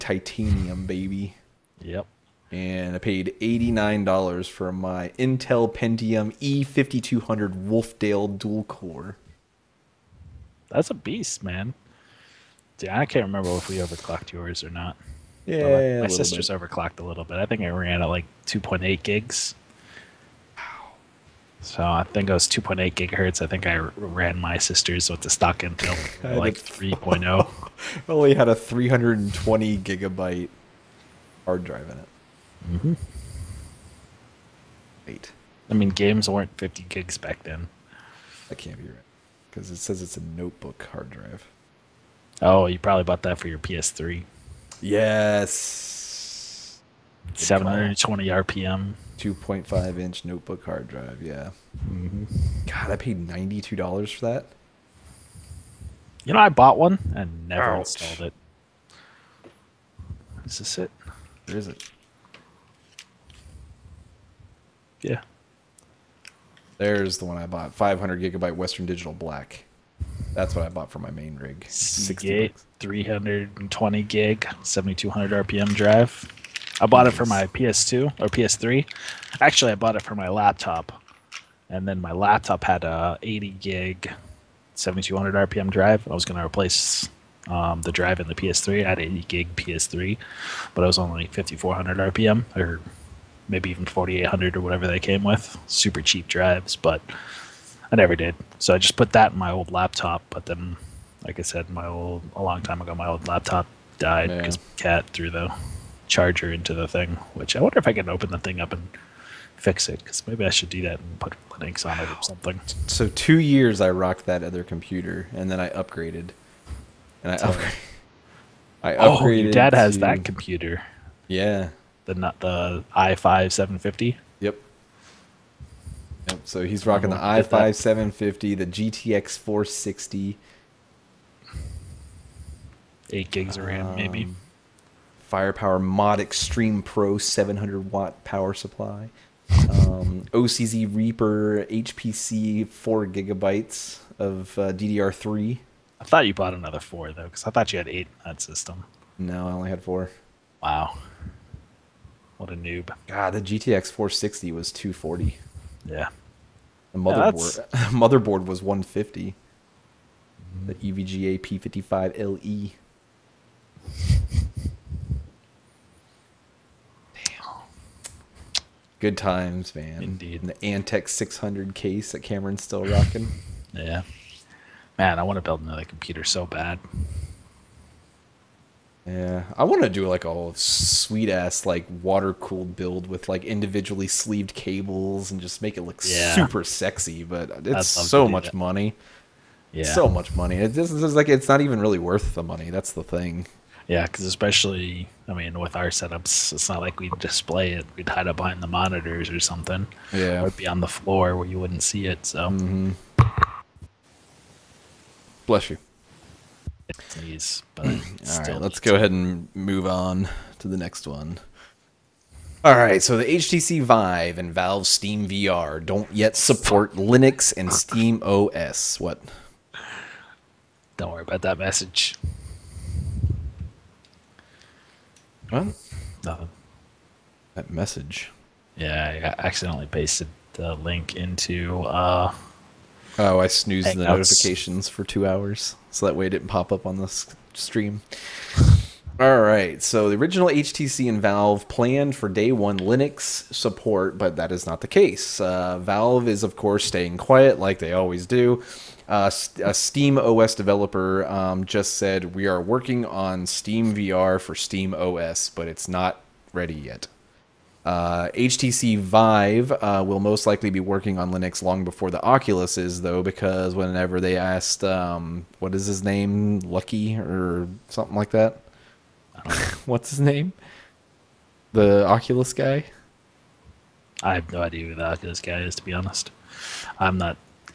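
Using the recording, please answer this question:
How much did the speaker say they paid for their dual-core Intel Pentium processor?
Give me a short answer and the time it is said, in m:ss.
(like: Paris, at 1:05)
$89, at 0:03.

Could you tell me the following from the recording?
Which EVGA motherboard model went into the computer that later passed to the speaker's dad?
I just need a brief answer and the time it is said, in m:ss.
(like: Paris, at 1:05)
EVGA P55LE, at 2:40.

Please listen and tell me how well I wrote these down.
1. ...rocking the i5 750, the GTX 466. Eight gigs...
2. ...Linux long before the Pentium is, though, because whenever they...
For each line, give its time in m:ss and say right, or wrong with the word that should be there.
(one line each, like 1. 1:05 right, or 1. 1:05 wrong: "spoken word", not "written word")
1. 2:06 wrong: "460", not "466"
2. 4:21 wrong: "Oculus", not "Pentium".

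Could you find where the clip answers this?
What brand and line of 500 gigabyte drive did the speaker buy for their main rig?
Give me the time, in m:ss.
1:08.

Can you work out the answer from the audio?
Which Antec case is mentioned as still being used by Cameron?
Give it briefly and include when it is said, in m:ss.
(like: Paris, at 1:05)
Antec 600, at 2:50.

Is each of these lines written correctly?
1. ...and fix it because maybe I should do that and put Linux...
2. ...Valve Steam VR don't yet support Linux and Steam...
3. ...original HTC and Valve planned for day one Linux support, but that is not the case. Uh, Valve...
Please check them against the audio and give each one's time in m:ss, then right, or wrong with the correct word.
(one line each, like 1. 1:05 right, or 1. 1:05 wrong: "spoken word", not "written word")
1. 1:48 right
2. 3:34 right
3. 4:00 right.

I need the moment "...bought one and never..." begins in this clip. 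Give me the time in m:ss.
0:56.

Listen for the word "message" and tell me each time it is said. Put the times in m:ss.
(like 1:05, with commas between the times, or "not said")
3:41, 3:47.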